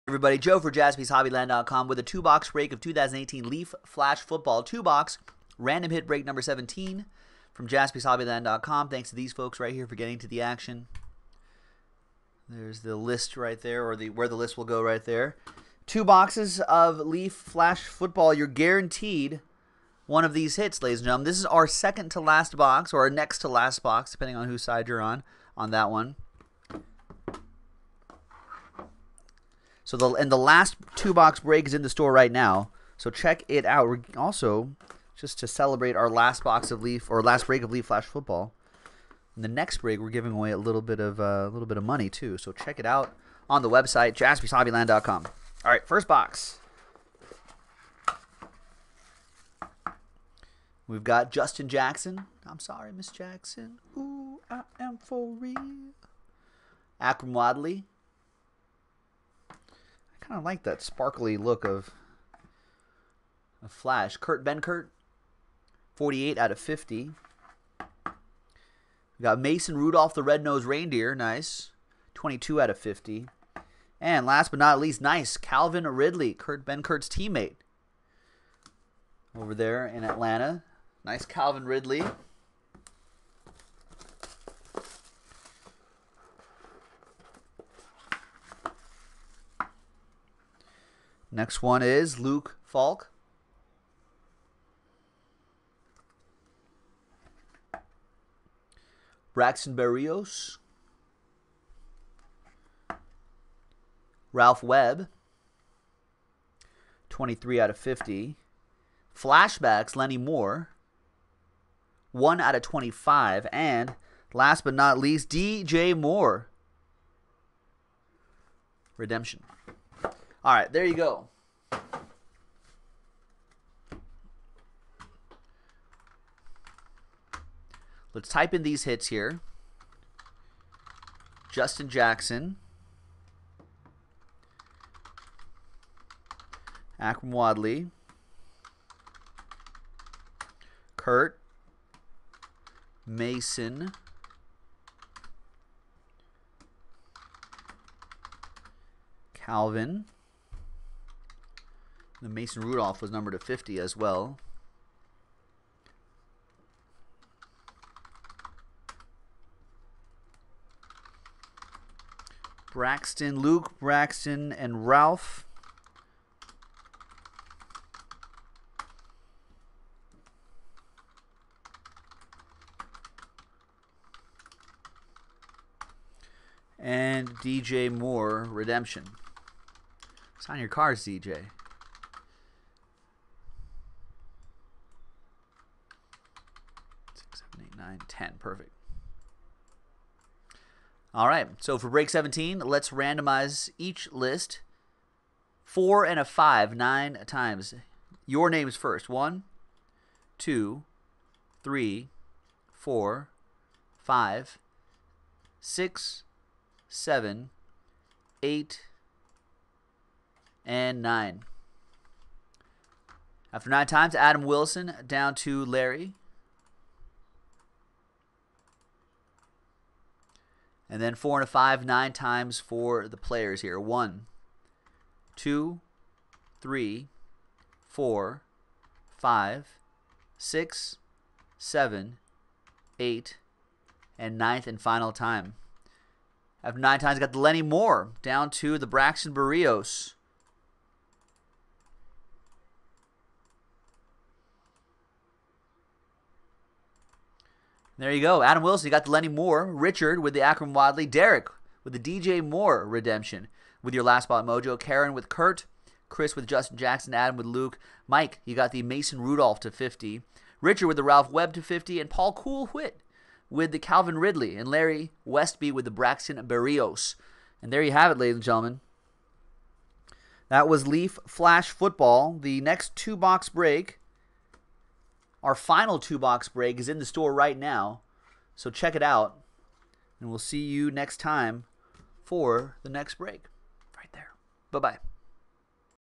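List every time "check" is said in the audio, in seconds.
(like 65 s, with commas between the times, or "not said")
33 s, 42 s, 278 s.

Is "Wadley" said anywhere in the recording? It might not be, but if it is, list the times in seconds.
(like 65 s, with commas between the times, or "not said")
57 s, 137 s, 250 s.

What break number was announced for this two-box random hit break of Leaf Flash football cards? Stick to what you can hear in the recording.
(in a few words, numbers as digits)
17.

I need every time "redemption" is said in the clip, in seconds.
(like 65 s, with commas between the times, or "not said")
118 s, 178 s, 252 s.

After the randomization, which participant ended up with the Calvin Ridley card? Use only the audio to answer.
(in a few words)
Paul Coolwit.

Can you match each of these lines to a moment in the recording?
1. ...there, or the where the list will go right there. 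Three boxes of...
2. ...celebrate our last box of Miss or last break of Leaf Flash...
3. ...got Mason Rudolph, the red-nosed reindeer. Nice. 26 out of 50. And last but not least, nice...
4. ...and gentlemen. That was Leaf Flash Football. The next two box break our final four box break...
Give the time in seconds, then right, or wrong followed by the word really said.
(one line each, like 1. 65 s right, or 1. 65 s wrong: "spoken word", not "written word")
1. 13 s wrong: "Two", not "Three"
2. 35 s wrong: "Leaf", not "Miss"
3. 69 s wrong: "22", not "26"
4. 268 s wrong: "two", not "four".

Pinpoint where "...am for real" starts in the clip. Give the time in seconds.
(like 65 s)
54 s.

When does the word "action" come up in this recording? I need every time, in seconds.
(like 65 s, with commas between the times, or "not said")
10 s.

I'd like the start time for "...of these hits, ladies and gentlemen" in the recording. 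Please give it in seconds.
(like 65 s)
20 s.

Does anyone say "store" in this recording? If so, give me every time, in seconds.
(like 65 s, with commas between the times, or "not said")
31 s, 277 s.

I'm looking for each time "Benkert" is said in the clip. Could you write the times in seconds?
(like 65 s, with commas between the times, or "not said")
64 s, 76 s.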